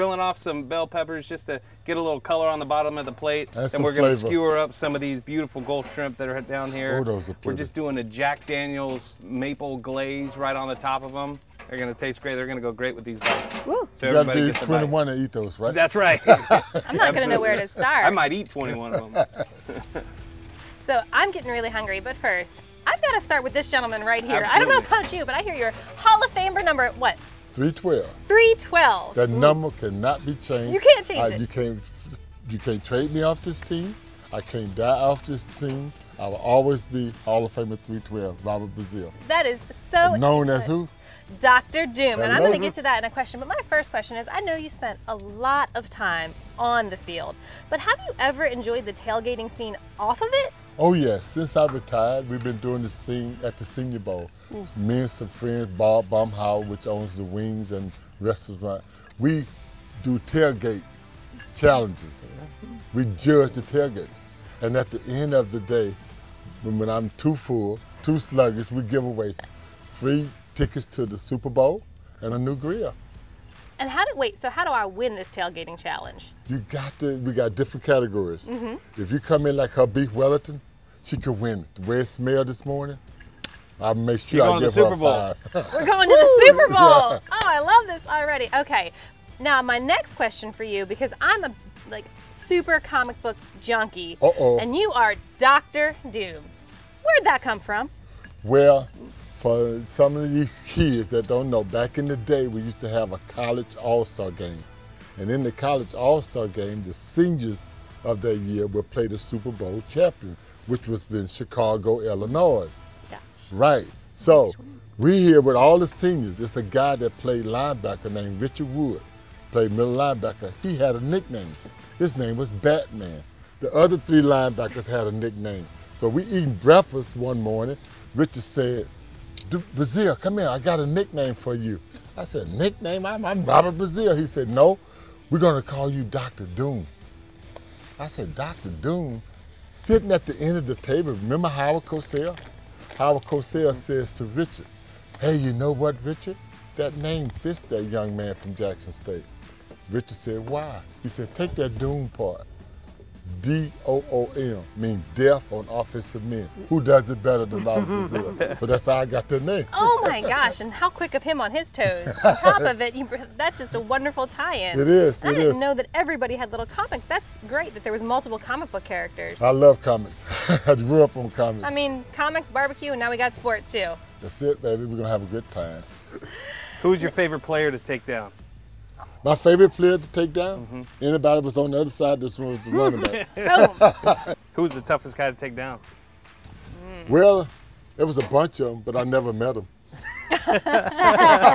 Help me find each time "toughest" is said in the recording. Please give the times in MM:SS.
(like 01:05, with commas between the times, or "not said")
03:04.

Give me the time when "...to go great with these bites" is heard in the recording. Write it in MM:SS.
00:12.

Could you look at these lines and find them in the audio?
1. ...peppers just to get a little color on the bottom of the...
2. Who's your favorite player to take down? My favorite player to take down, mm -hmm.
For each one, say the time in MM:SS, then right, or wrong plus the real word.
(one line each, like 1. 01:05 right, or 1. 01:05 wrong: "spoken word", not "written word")
1. 00:00 right
2. 02:56 right.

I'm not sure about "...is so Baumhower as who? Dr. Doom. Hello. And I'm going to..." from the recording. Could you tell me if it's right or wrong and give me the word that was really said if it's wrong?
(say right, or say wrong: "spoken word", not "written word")
wrong: "Known", not "Baumhower".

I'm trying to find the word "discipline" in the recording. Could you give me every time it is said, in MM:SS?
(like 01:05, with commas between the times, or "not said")
not said.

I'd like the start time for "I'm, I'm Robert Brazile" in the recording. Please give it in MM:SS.
02:13.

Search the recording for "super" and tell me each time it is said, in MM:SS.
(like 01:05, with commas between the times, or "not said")
01:11, 01:26, 01:32, 01:49.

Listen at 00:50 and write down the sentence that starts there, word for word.
Oh yes, since I retired, we've been doing this thing at the Senior Bowl.